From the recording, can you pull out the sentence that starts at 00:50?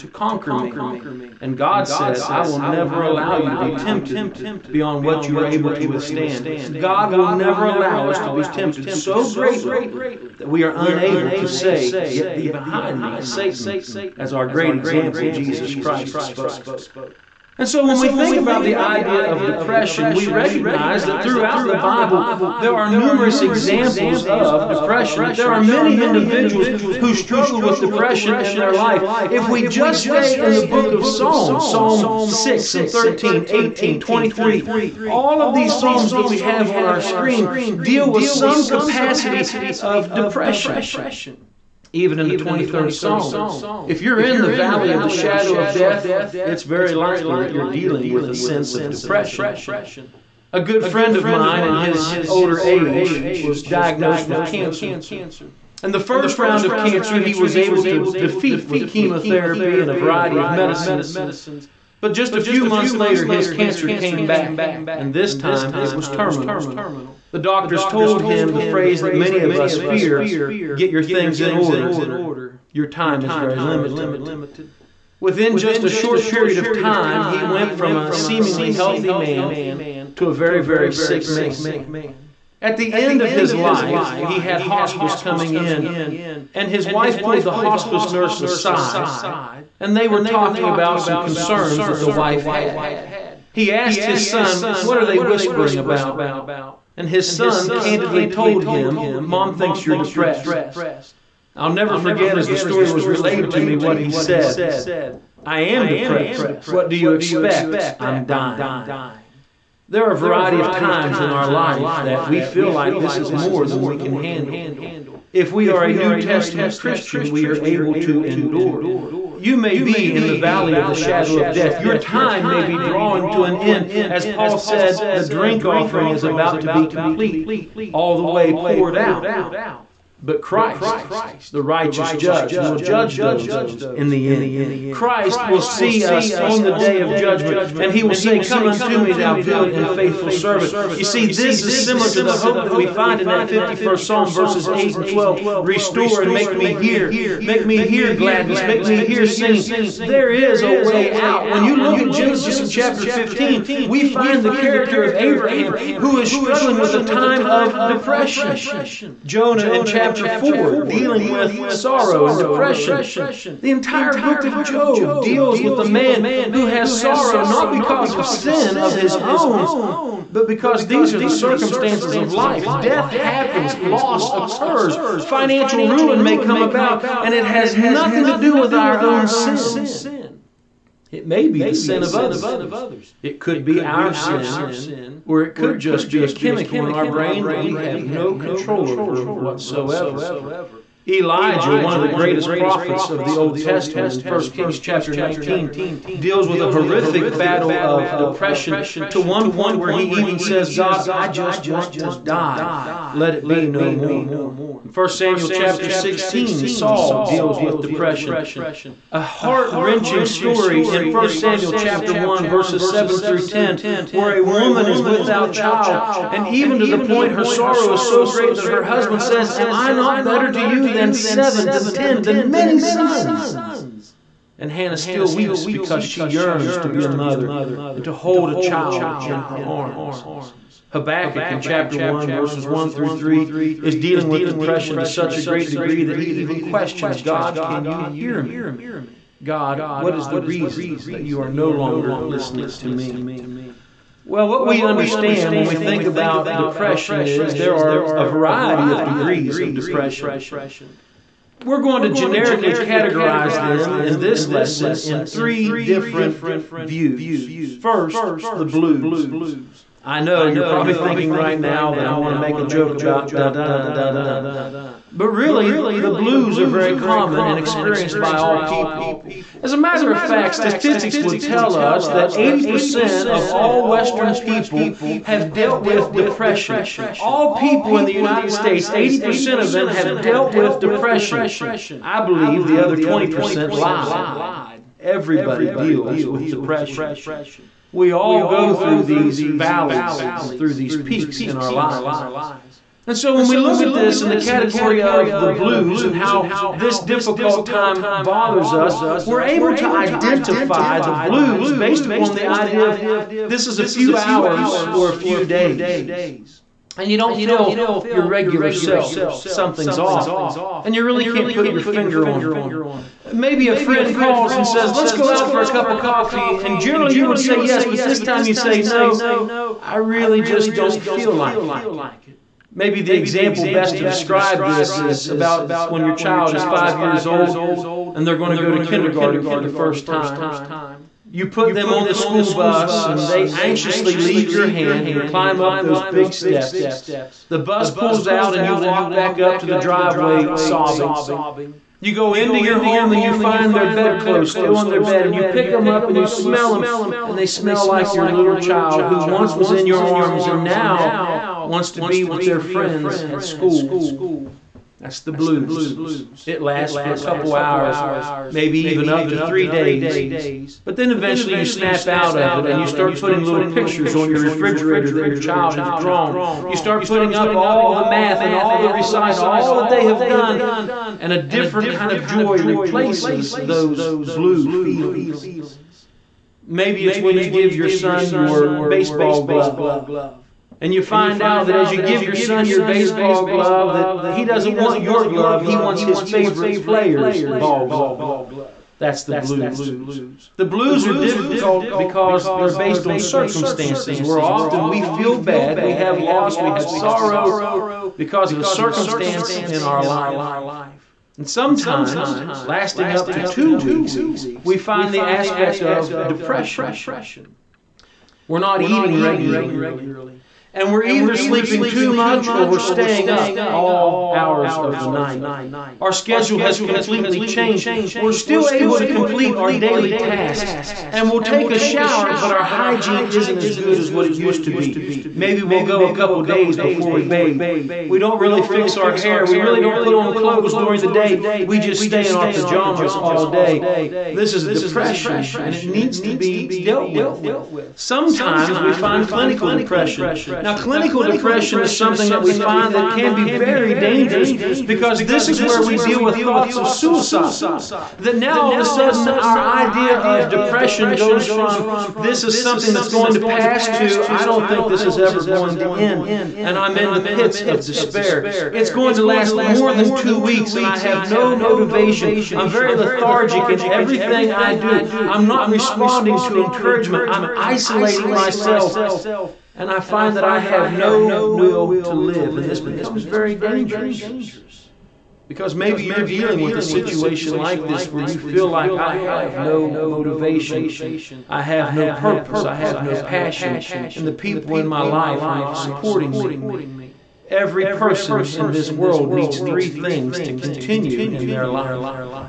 A good friend of mine in his older age was diagnosed with cancer.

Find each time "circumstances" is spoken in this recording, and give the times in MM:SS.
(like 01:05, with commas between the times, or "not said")
02:51, 06:33, 06:38.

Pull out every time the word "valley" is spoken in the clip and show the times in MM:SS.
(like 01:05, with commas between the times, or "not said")
00:44, 02:00, 04:49.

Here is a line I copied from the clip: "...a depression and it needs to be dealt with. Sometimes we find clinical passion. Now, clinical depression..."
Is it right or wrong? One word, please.
wrong.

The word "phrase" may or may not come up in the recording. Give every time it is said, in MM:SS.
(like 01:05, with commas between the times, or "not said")
01:08.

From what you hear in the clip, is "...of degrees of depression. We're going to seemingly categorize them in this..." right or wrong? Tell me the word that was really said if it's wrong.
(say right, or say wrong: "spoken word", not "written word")
wrong: "generically", not "seemingly".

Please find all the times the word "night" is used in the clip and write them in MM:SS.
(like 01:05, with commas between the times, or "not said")
06:55.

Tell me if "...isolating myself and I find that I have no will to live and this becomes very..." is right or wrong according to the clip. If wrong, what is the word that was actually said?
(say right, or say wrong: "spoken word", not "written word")
right.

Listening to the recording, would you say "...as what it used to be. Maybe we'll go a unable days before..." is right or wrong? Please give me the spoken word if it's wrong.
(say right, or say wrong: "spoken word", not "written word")
wrong: "couple", not "unable".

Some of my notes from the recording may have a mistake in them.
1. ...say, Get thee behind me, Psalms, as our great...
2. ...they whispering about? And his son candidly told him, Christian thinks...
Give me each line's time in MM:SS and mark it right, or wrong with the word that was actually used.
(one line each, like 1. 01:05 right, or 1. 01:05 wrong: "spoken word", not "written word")
1. 00:11 wrong: "Satan", not "Psalms"
2. 01:35 wrong: "Mom", not "Christian".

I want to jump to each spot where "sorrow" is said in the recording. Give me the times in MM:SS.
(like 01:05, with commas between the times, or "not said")
02:41, 02:46, 03:37, 06:36.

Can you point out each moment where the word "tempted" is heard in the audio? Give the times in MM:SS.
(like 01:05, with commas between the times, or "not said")
00:03, 00:08.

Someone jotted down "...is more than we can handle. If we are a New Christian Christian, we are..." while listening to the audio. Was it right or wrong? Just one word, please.
wrong.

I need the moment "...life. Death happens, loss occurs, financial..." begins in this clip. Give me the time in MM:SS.
02:52.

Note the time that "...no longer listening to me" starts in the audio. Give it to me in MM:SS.
04:01.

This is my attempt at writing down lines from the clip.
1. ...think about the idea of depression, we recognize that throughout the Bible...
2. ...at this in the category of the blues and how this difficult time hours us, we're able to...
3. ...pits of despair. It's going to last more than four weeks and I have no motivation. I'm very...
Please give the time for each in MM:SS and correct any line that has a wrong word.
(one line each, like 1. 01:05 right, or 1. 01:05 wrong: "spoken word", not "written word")
1. 00:18 right
2. 04:53 wrong: "bothers", not "hours"
3. 07:37 wrong: "two", not "four".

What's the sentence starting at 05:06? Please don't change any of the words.
And you don't feel your regular self.